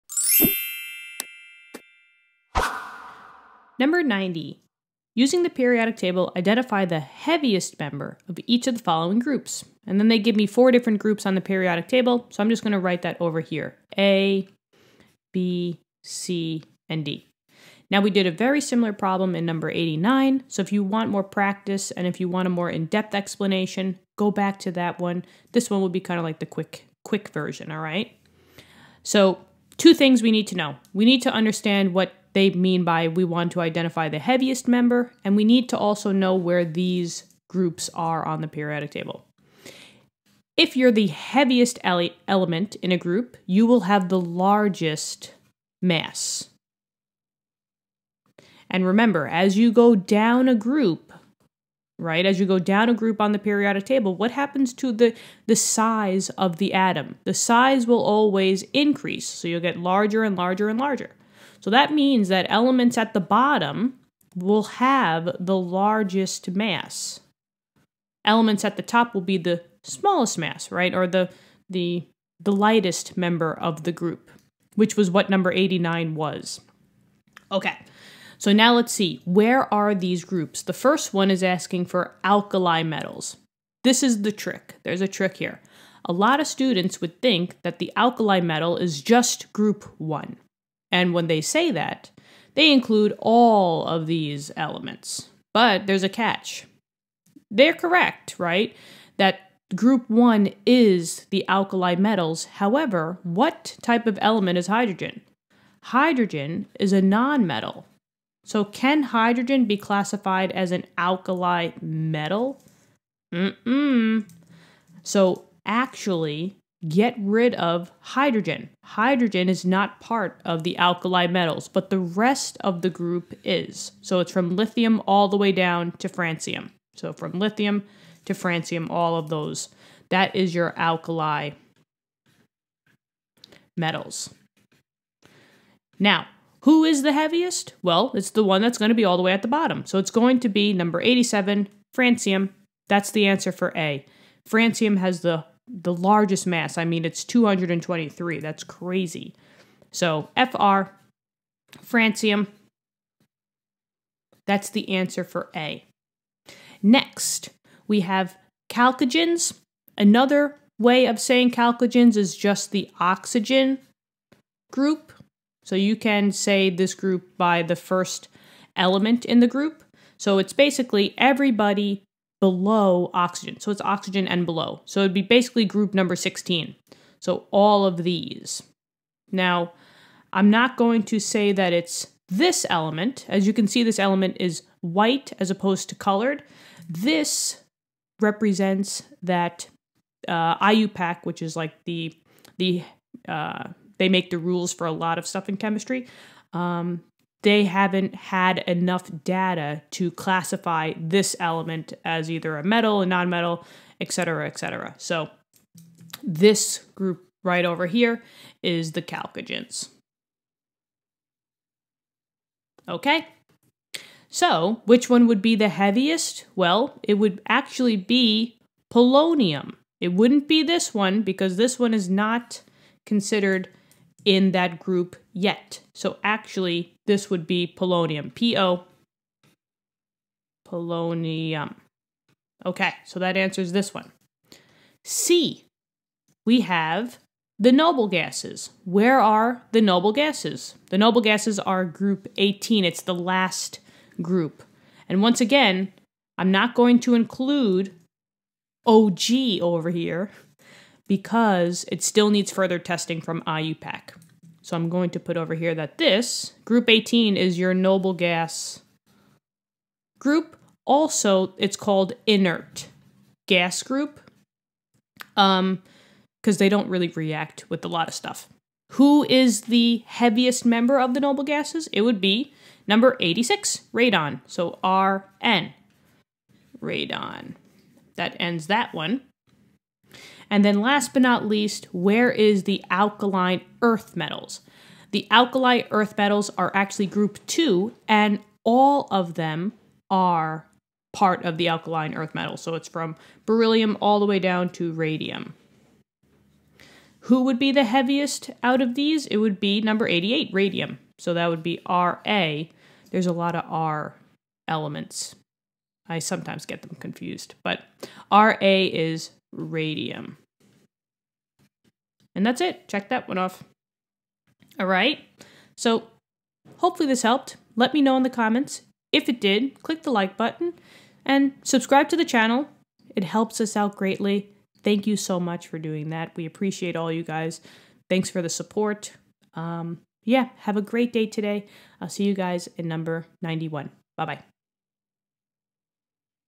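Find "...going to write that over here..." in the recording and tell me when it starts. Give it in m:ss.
0:12.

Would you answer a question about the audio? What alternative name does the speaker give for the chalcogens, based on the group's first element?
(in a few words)
oxygen group.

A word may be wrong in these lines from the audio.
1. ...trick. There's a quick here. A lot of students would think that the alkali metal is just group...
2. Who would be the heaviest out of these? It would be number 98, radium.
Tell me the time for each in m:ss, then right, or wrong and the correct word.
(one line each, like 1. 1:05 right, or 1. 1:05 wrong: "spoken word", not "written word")
1. 1:24 wrong: "trick", not "quick"
2. 4:57 wrong: "88", not "98".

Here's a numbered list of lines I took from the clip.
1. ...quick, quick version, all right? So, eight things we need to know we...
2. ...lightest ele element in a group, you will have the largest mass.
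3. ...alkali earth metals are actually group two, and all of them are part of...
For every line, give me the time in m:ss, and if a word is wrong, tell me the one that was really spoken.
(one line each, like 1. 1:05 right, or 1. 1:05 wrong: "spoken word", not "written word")
1. 0:26 wrong: "two", not "eight"
2. 0:41 wrong: "heaviest", not "lightest"
3. 4:45 right.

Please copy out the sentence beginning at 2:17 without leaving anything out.
Well, it's the one that's going to be all the way at the bottom.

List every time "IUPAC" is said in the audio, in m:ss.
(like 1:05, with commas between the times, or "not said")
3:10, 4:13.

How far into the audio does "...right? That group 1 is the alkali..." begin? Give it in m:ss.
1:38.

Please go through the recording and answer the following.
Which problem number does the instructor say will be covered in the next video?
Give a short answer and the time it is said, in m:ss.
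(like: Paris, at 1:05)
91, at 5:32.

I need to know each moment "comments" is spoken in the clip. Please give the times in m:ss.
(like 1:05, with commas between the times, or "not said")
5:18.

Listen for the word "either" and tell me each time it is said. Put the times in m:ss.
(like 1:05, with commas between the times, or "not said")
3:22.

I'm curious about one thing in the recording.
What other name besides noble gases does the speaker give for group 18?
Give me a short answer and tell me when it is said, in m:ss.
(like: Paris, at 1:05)
inert gas group, at 4:22.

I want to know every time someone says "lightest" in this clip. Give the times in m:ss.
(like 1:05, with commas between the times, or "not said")
1:12.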